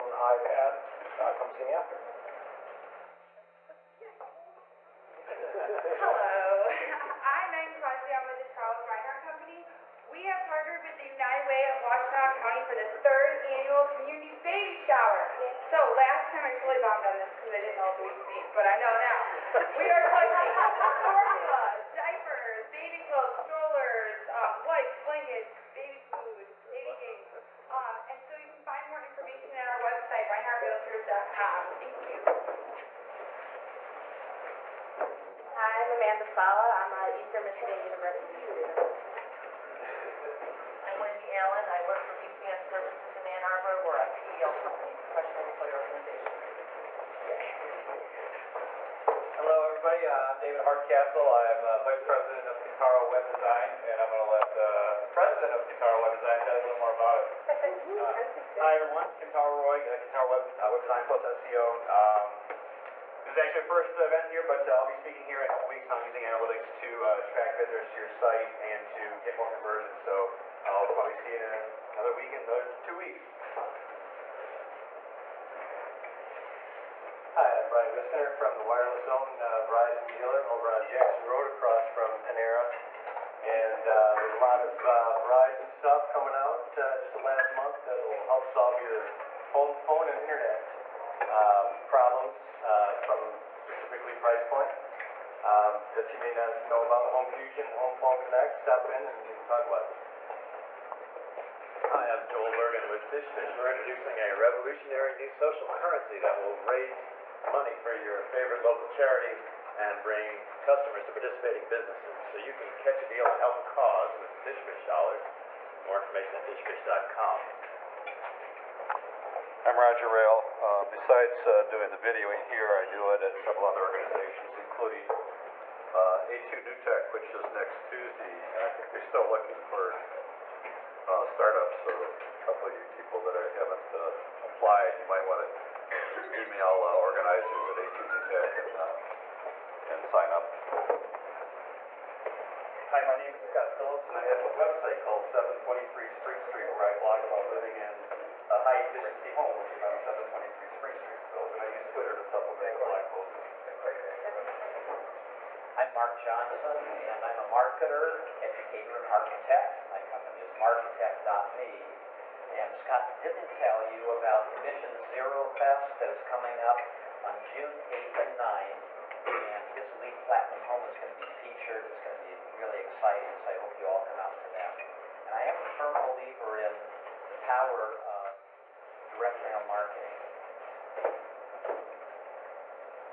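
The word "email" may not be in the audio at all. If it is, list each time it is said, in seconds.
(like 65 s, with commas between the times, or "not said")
136 s.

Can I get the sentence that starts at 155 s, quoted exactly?
I'm Mark Johnson, and I'm a marketer, educator, and architect.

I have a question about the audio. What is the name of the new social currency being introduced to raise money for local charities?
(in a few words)
FishFish dollars.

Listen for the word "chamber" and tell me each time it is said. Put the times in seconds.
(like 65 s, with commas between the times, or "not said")
not said.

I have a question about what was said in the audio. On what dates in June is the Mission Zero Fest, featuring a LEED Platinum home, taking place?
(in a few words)
June 8th and 9th.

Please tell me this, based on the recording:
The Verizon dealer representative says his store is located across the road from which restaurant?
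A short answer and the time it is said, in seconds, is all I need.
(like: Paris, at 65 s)
Panera, at 82 s.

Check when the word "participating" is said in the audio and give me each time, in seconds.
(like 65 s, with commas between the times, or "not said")
111 s.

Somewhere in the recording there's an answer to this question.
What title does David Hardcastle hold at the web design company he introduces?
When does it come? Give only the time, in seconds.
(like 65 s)
51 s.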